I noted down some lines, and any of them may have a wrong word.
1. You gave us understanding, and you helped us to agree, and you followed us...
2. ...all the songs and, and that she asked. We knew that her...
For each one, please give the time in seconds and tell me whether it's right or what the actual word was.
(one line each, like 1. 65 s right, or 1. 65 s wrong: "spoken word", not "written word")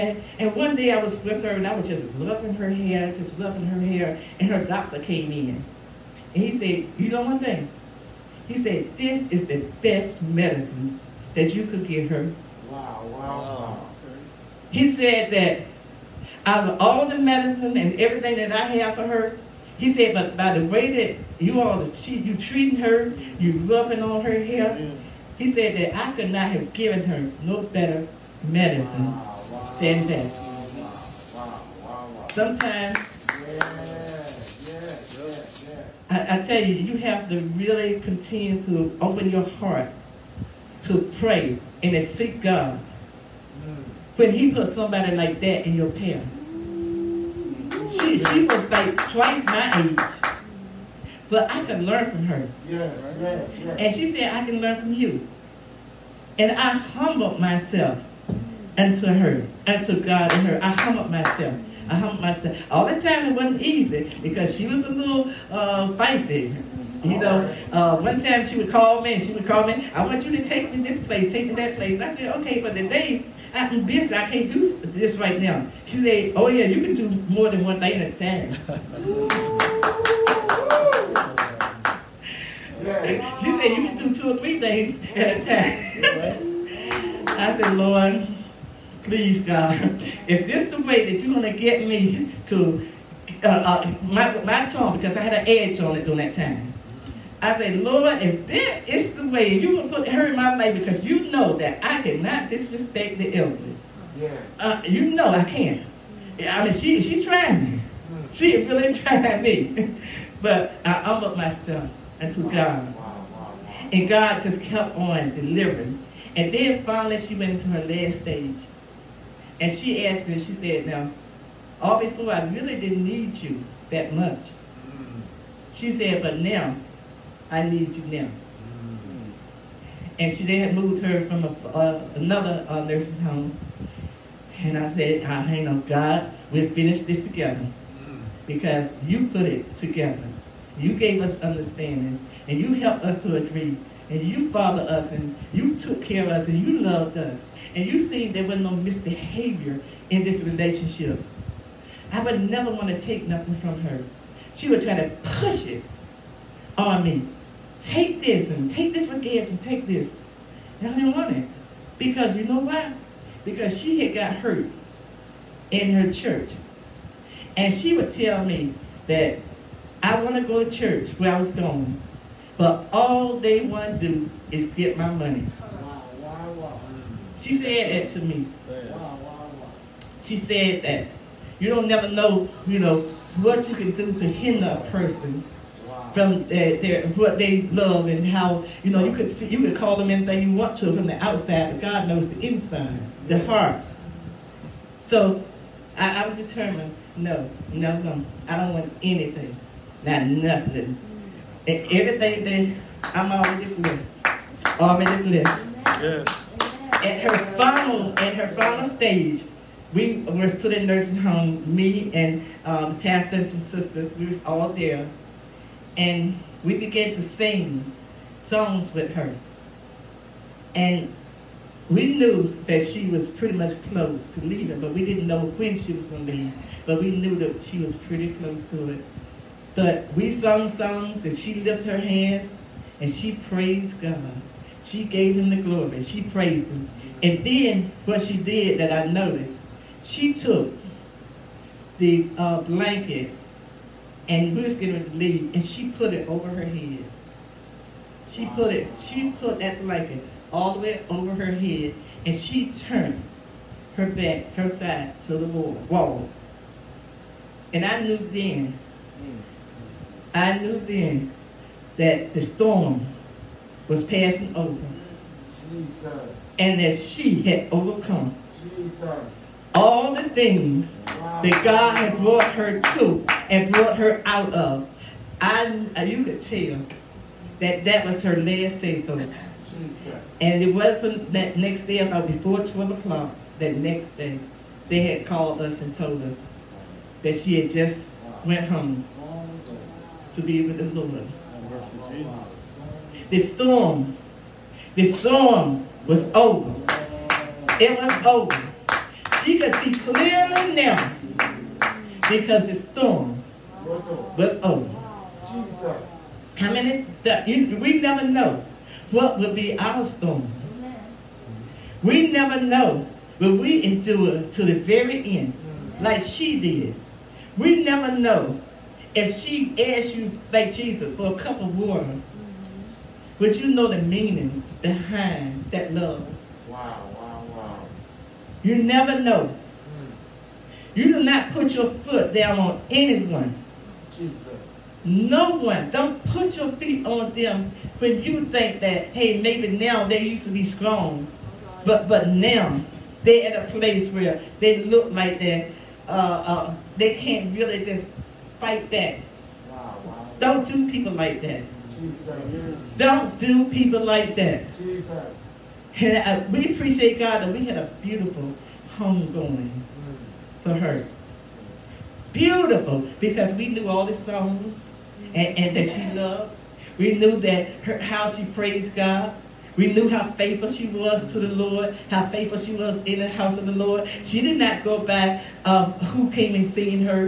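1. 140 s right
2. 363 s wrong: "loved", not "asked".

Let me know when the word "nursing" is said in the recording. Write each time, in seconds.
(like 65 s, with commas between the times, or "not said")
132 s, 210 s.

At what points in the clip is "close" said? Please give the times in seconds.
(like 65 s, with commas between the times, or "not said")
223 s, 228 s.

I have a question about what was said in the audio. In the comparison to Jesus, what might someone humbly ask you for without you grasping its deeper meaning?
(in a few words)
a cup of water.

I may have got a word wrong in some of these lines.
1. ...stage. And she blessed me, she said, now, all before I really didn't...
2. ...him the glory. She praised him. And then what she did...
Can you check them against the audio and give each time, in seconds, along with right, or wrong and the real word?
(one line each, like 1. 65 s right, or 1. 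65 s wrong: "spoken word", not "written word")
1. 118 s wrong: "asked", not "blessed"
2. 235 s right.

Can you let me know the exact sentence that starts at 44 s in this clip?
When he puts somebody like that in your path, she, she was like twice my age.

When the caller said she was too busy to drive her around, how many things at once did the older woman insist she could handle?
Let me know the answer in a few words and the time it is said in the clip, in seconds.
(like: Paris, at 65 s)
two or three things, at 84 s.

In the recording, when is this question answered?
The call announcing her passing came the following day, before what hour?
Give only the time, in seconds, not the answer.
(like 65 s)
282 s.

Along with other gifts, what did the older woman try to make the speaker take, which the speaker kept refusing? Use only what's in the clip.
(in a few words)
gas.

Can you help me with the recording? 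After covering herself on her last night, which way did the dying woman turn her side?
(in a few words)
to the wall.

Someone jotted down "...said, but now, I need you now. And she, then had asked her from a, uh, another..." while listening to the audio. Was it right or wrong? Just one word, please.
wrong.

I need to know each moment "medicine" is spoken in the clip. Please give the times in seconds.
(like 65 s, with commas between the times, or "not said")
10 s, 17 s, 28 s.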